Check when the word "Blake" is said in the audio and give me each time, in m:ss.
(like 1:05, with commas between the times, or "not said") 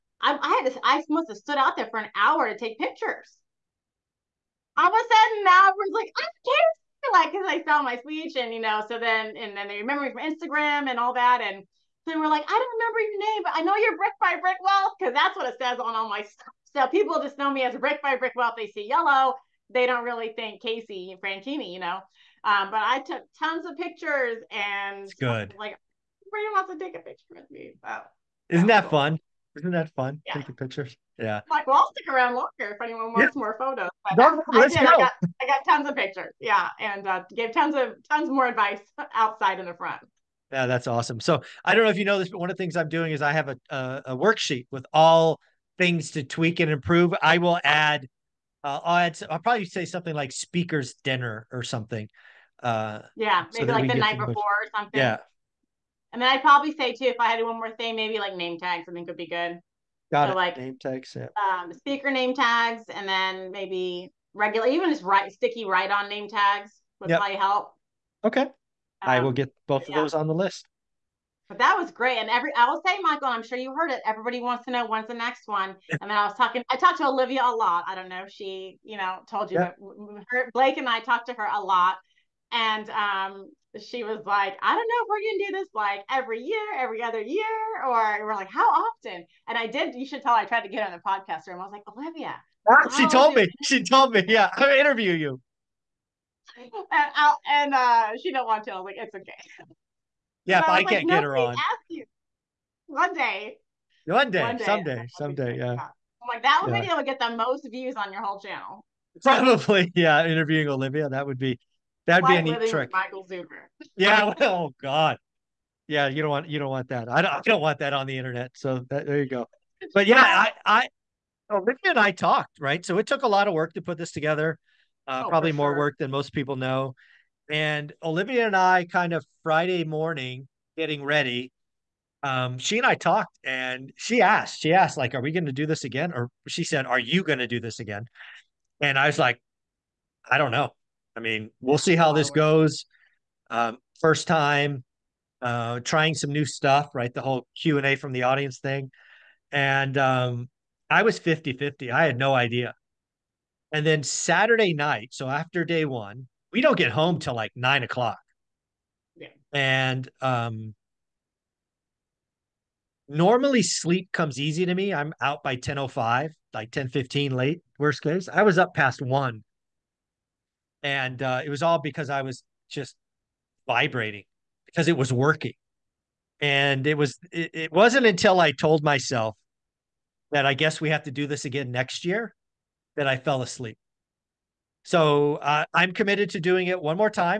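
1:20.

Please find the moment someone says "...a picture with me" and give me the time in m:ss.
0:26.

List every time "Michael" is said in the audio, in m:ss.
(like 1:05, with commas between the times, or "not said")
1:12, 1:52.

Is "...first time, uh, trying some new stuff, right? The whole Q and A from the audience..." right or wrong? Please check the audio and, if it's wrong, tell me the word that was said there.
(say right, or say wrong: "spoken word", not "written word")
right.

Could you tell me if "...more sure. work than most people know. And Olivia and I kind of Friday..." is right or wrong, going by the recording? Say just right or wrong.
right.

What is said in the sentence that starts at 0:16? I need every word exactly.
So people just know me as Brick by Brick Wealth.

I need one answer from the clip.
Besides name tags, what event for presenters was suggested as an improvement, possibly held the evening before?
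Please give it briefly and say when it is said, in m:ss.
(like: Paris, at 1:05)
Speakers dinner, at 0:50.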